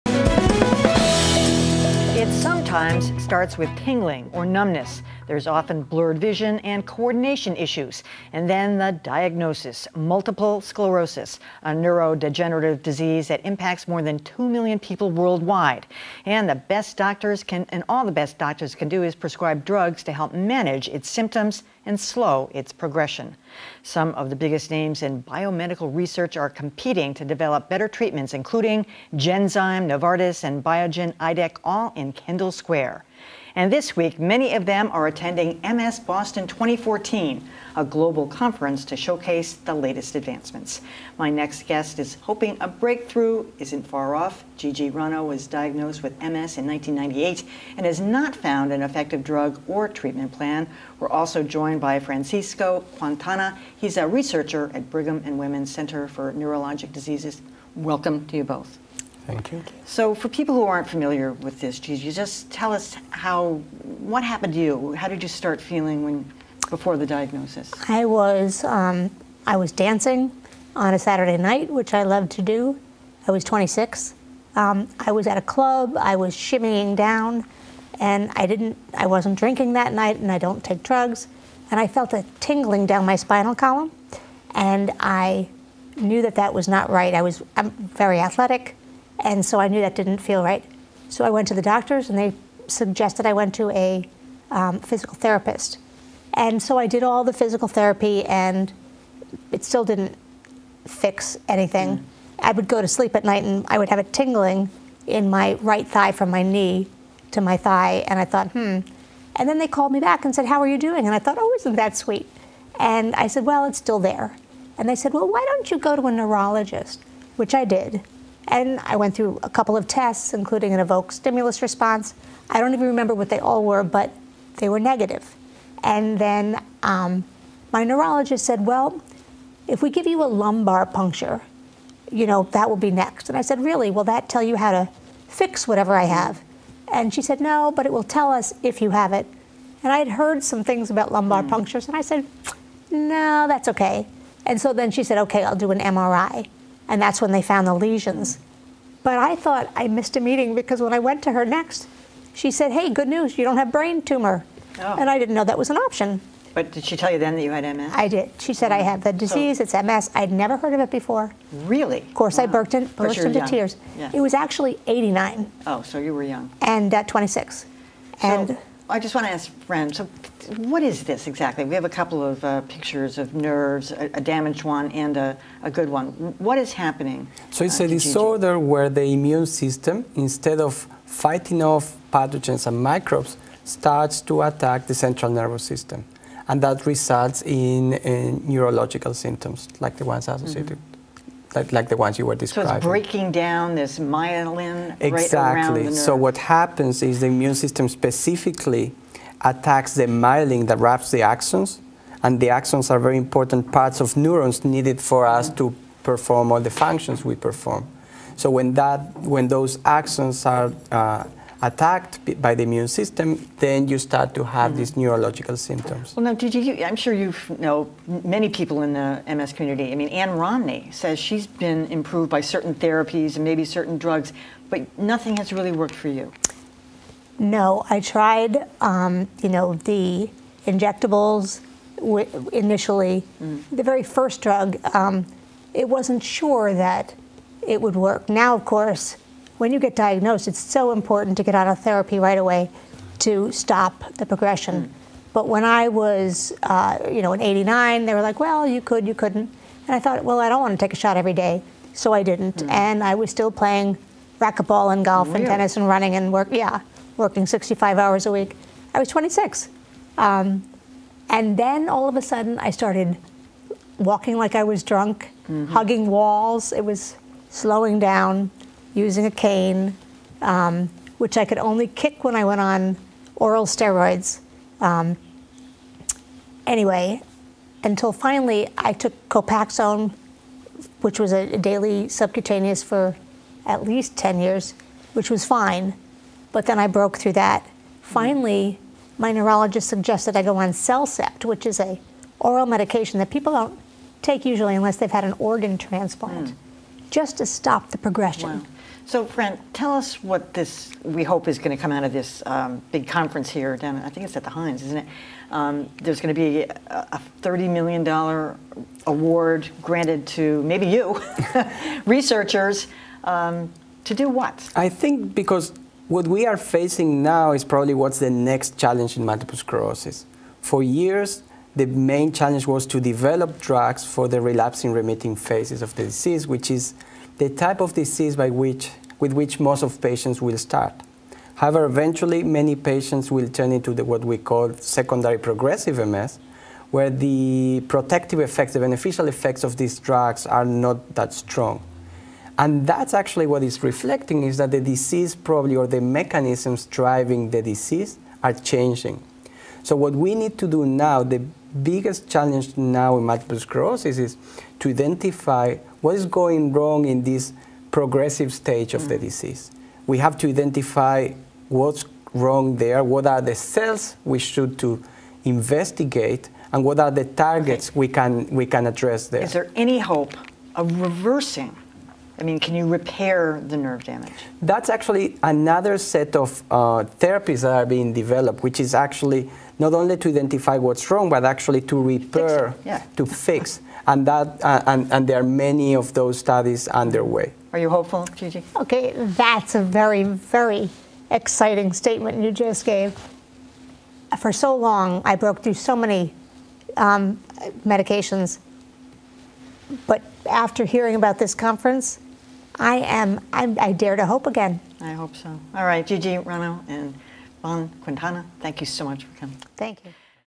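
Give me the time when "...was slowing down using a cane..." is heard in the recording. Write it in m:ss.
4:26.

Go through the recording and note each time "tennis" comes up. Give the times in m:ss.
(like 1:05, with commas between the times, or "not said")
4:15.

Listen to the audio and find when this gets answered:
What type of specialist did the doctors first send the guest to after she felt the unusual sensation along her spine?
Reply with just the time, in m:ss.
1:34.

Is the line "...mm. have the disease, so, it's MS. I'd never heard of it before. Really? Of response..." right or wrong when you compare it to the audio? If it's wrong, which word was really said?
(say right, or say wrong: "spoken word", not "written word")
wrong: "course", not "response".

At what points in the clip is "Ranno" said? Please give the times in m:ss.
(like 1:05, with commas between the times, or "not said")
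0:44, 6:46.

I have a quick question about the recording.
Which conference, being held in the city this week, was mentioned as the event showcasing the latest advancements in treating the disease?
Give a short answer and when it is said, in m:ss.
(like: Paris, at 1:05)
MS Boston 2014, at 0:35.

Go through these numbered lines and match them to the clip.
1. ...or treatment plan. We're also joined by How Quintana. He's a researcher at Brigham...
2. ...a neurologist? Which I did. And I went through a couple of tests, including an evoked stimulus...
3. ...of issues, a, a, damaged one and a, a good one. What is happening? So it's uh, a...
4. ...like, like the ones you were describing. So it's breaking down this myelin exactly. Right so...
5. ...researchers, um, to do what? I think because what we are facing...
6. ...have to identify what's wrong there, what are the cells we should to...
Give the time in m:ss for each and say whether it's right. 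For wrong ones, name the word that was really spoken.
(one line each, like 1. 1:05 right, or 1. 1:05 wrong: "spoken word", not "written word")
1. 0:49 wrong: "Francisco", not "How"
2. 1:56 right
3. 2:53 wrong: "nerves", not "issues"
4. 3:11 right
5. 5:12 right
6. 6:00 right.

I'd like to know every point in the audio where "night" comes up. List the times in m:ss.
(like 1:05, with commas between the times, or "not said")
1:11, 1:19, 1:43.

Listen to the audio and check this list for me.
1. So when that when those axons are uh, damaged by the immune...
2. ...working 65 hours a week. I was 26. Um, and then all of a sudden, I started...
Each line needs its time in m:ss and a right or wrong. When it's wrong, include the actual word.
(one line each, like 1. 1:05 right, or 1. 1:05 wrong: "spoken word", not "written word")
1. 3:28 wrong: "attacked", not "damaged"
2. 4:17 right.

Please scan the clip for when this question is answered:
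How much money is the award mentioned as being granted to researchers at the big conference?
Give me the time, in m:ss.
5:07.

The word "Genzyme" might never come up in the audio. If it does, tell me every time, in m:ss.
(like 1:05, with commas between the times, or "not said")
0:29.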